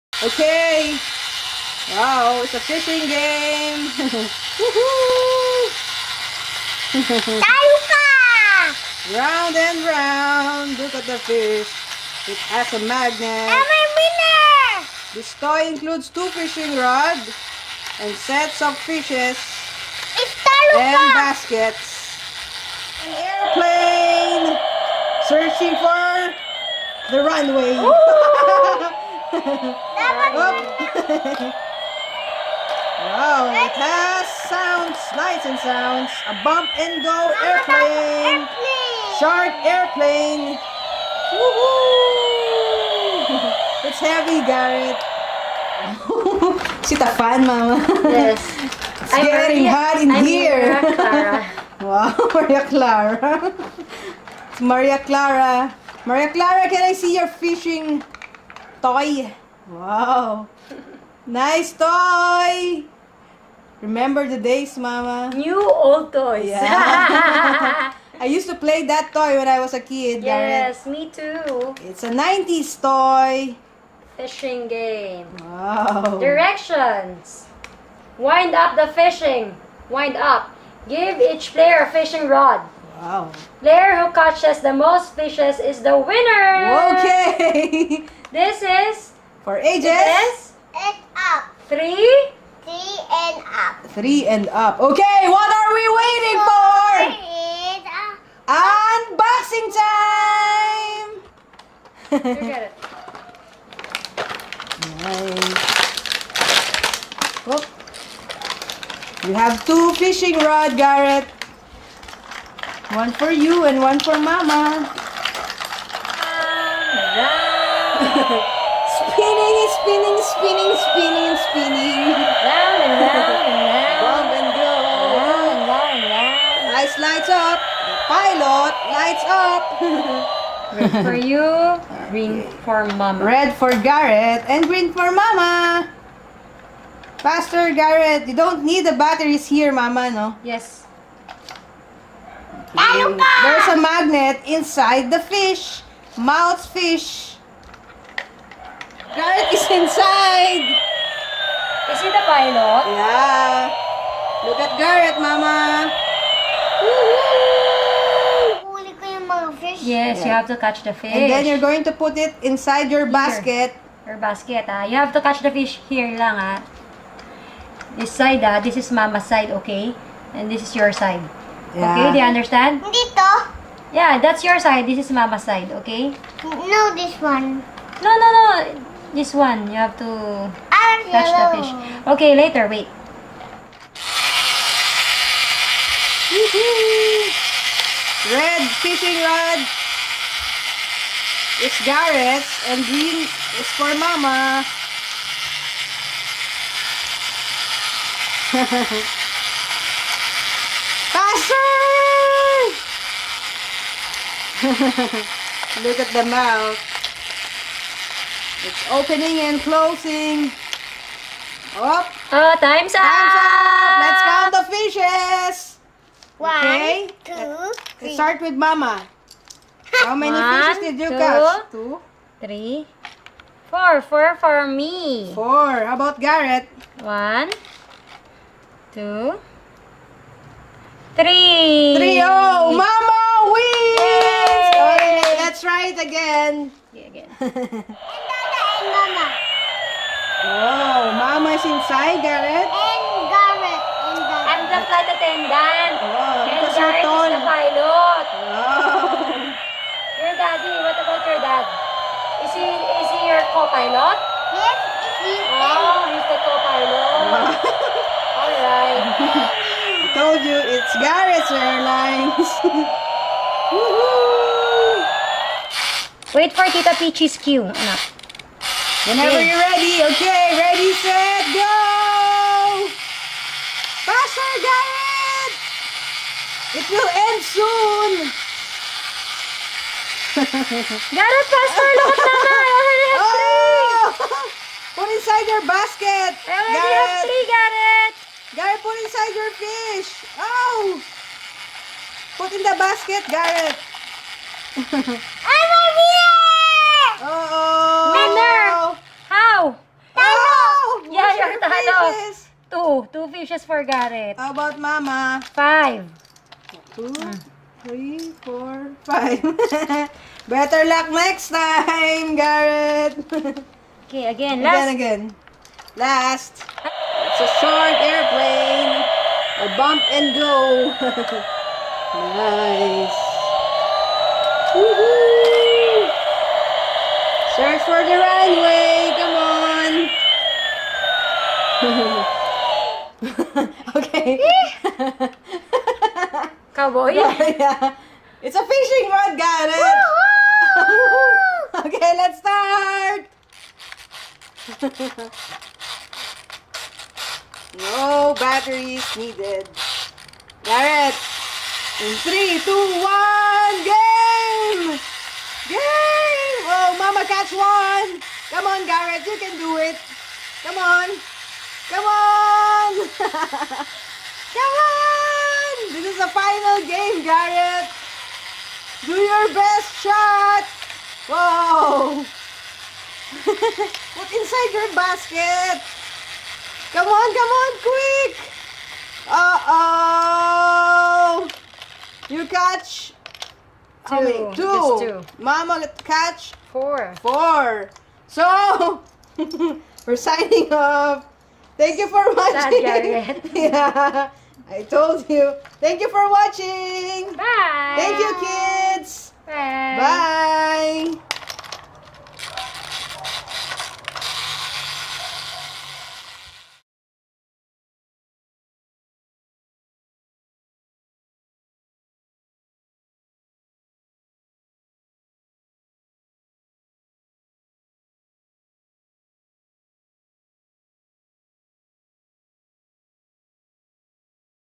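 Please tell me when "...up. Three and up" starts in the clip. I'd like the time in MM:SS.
01:33.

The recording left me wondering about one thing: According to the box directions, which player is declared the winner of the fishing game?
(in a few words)
Player who catches the most fishes.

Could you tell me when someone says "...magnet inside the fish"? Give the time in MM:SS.
02:23.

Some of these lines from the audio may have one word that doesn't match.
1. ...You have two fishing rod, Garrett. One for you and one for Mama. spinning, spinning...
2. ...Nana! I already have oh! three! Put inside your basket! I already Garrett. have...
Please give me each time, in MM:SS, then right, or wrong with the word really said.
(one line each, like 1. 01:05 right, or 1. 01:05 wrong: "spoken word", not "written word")
1. 01:49 right
2. 04:42 right.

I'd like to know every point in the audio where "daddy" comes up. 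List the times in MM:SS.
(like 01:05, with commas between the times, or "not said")
04:10.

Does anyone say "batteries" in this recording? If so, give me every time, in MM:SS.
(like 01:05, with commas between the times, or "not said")
02:18, 05:48.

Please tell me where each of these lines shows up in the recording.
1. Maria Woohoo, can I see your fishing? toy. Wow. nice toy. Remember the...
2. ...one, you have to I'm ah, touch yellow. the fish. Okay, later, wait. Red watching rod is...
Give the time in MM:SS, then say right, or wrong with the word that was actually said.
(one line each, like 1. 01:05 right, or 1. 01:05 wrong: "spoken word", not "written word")
1. 00:56 wrong: "Clara", not "Woohoo"
2. 02:59 wrong: "fishing", not "watching".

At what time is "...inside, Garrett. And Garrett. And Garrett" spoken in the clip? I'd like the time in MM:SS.
04:01.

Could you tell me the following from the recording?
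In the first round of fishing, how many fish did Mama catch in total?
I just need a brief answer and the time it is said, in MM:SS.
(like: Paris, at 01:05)
4, at 03:44.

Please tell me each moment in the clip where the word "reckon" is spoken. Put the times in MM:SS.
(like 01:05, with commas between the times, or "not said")
not said.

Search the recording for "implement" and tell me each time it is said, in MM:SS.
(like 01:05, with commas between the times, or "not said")
not said.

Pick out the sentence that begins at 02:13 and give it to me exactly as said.
Red for Garrett and green for mama.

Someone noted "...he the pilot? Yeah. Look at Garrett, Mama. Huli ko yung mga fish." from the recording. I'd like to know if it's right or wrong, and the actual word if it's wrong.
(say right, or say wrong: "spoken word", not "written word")
right.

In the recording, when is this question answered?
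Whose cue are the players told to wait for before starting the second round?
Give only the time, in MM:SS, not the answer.
04:26.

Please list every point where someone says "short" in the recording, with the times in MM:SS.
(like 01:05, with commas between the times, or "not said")
05:17.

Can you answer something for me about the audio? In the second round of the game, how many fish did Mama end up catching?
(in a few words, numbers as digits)
5.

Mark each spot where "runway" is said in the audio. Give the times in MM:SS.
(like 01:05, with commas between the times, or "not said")
00:27, 05:28.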